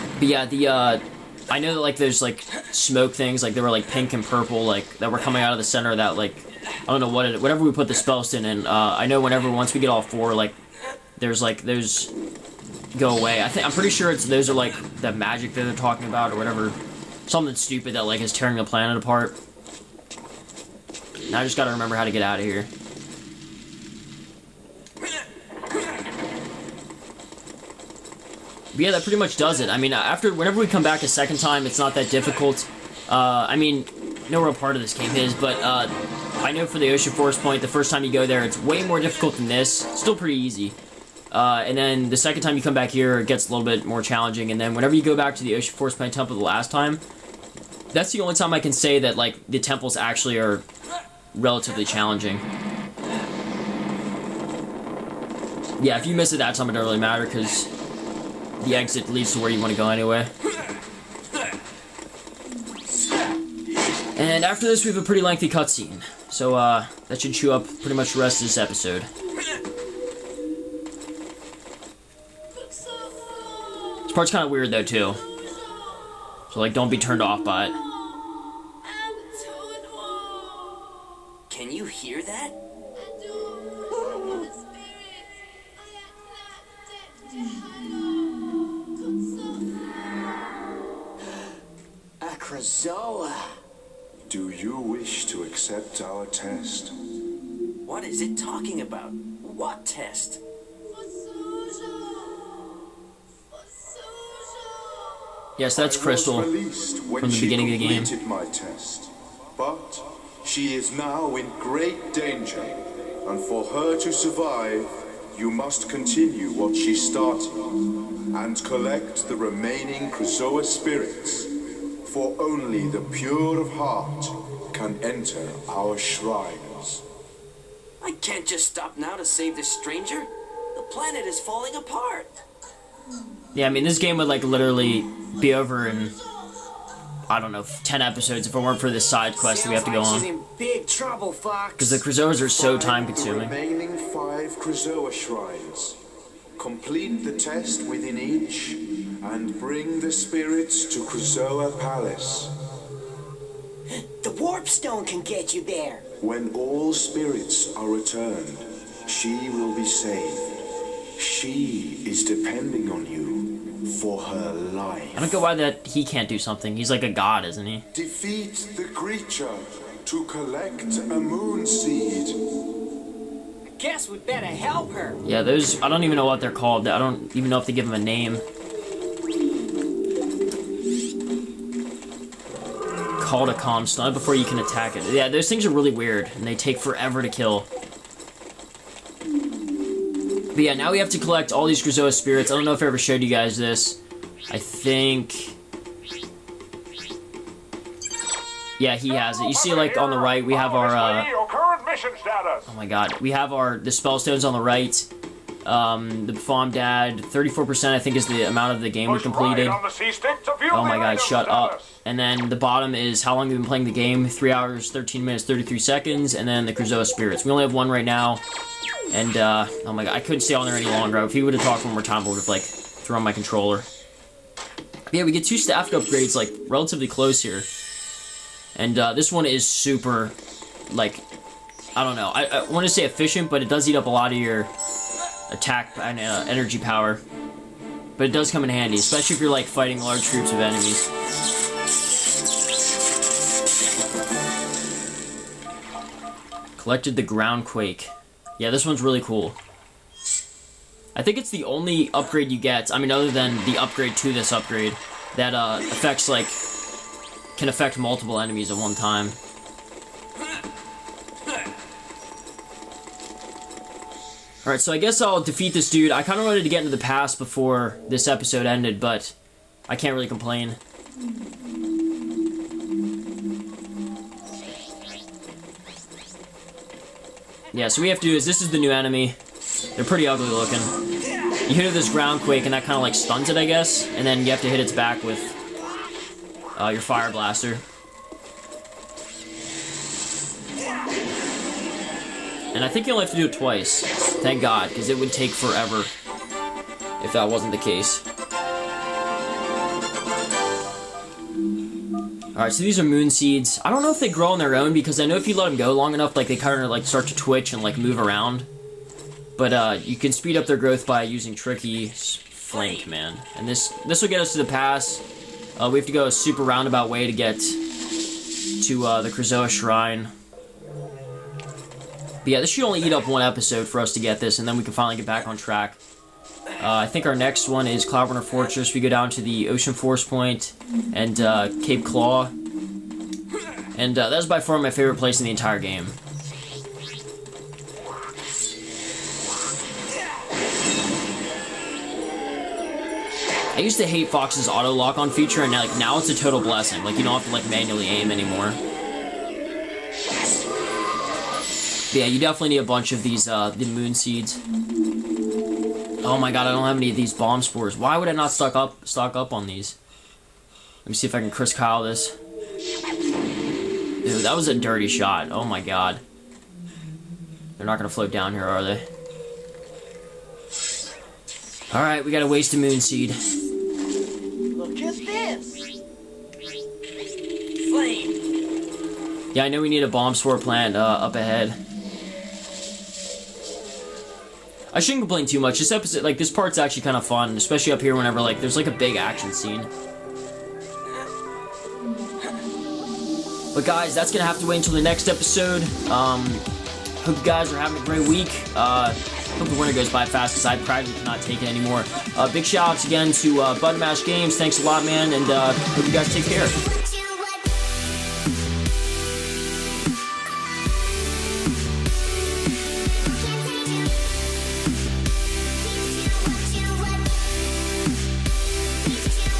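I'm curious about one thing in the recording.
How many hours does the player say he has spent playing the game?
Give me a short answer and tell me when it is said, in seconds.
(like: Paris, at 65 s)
3 hours, at 214 s.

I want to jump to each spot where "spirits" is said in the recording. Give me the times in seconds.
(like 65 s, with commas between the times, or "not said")
120 s, 150 s, 156 s, 192 s, 217 s.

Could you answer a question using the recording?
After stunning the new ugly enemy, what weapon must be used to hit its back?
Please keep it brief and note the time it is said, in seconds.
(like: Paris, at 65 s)
Fire blaster, at 287 s.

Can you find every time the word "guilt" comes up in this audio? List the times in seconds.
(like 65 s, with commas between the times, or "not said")
not said.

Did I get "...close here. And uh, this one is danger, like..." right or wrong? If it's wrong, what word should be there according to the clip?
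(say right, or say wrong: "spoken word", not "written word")
wrong: "super", not "danger".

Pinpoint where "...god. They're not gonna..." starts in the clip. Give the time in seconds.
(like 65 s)
365 s.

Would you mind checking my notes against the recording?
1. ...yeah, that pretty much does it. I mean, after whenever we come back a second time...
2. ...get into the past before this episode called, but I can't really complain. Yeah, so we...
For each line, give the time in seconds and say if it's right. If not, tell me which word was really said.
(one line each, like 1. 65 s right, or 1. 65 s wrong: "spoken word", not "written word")
1. 28 s right
2. 266 s wrong: "ended", not "called".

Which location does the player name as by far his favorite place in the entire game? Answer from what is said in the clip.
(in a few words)
Cape Claw.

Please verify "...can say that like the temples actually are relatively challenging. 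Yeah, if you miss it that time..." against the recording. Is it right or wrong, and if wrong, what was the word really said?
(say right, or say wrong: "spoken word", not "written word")
right.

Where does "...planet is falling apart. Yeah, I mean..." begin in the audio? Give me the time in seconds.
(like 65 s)
130 s.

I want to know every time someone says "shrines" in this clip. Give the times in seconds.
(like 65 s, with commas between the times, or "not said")
125 s, 145 s, 319 s.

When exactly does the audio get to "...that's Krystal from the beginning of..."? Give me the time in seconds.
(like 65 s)
105 s.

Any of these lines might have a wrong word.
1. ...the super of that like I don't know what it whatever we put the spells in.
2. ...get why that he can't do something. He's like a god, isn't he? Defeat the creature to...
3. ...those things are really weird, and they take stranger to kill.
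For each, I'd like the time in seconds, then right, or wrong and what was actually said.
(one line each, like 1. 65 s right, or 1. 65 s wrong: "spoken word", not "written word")
1. 5 s wrong: "center", not "super"
2. 165 s right
3. 185 s wrong: "forever", not "stranger".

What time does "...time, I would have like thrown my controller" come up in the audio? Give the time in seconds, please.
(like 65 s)
222 s.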